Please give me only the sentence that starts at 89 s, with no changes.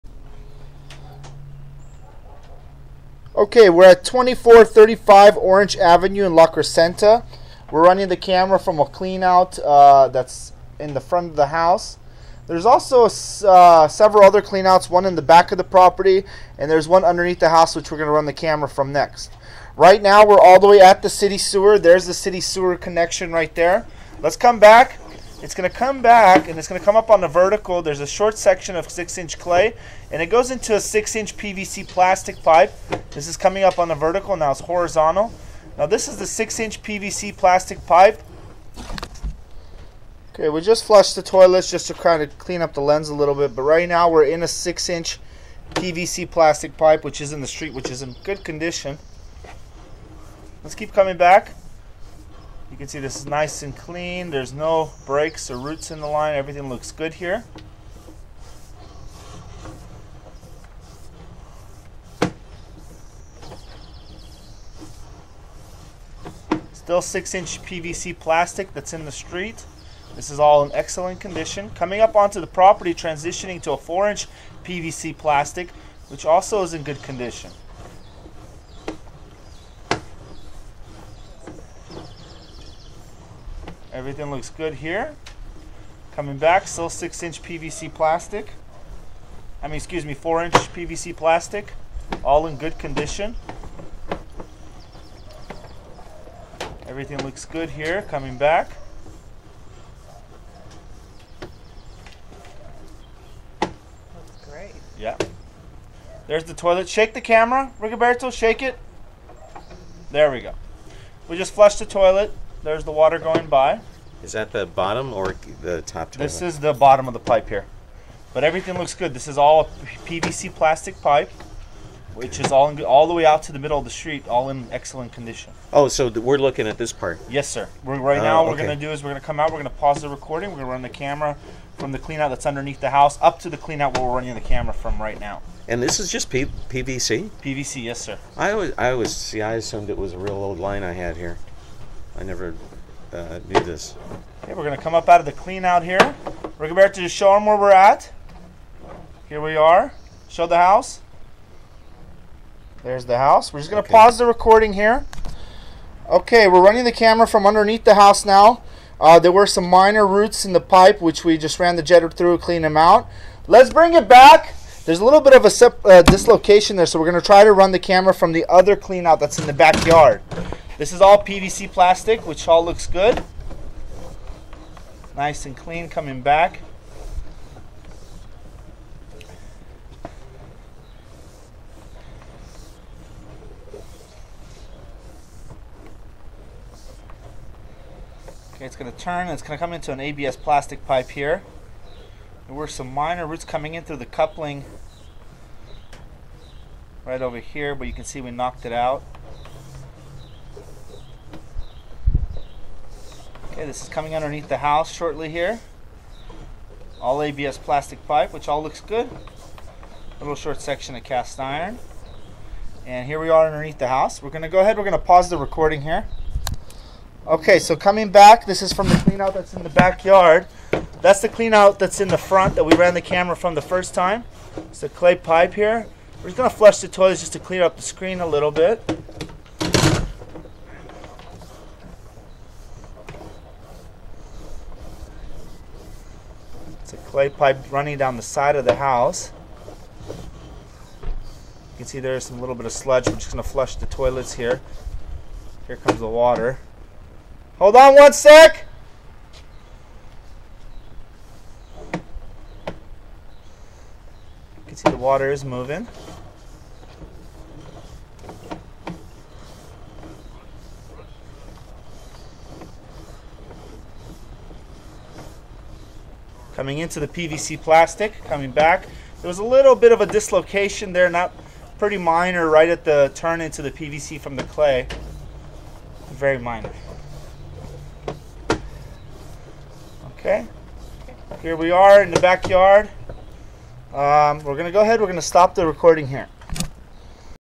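I mean, excuse me, four inch PVC plastic, all in good condition.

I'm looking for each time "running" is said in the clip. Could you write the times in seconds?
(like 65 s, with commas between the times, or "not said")
7 s, 134 s, 156 s, 237 s.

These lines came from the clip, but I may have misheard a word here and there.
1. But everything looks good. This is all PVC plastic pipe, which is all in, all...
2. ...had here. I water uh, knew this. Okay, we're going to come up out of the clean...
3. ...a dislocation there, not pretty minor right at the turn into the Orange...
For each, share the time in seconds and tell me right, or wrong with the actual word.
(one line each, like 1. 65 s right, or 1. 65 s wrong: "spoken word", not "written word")
1. 118 s right
2. 140 s wrong: "never", not "water"
3. 270 s wrong: "PVC", not "Orange".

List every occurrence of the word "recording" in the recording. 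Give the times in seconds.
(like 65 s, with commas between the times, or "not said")
130 s, 154 s, 215 s, 285 s.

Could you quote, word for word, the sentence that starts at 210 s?
Little short section of cast iron.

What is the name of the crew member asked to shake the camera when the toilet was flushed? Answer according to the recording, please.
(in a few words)
Rigoberto.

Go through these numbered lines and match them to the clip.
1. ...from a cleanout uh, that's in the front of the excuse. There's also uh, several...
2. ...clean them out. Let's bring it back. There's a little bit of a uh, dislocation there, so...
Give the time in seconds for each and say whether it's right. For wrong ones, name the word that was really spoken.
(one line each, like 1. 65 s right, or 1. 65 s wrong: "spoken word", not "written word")
1. 8 s wrong: "house", not "excuse"
2. 162 s right.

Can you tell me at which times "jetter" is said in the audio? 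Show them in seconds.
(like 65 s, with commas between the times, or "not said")
161 s.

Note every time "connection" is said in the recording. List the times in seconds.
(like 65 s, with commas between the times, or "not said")
22 s.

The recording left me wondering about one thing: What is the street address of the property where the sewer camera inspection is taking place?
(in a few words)
2435 Orange Avenue.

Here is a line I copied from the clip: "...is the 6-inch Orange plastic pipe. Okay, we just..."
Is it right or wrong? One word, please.
wrong.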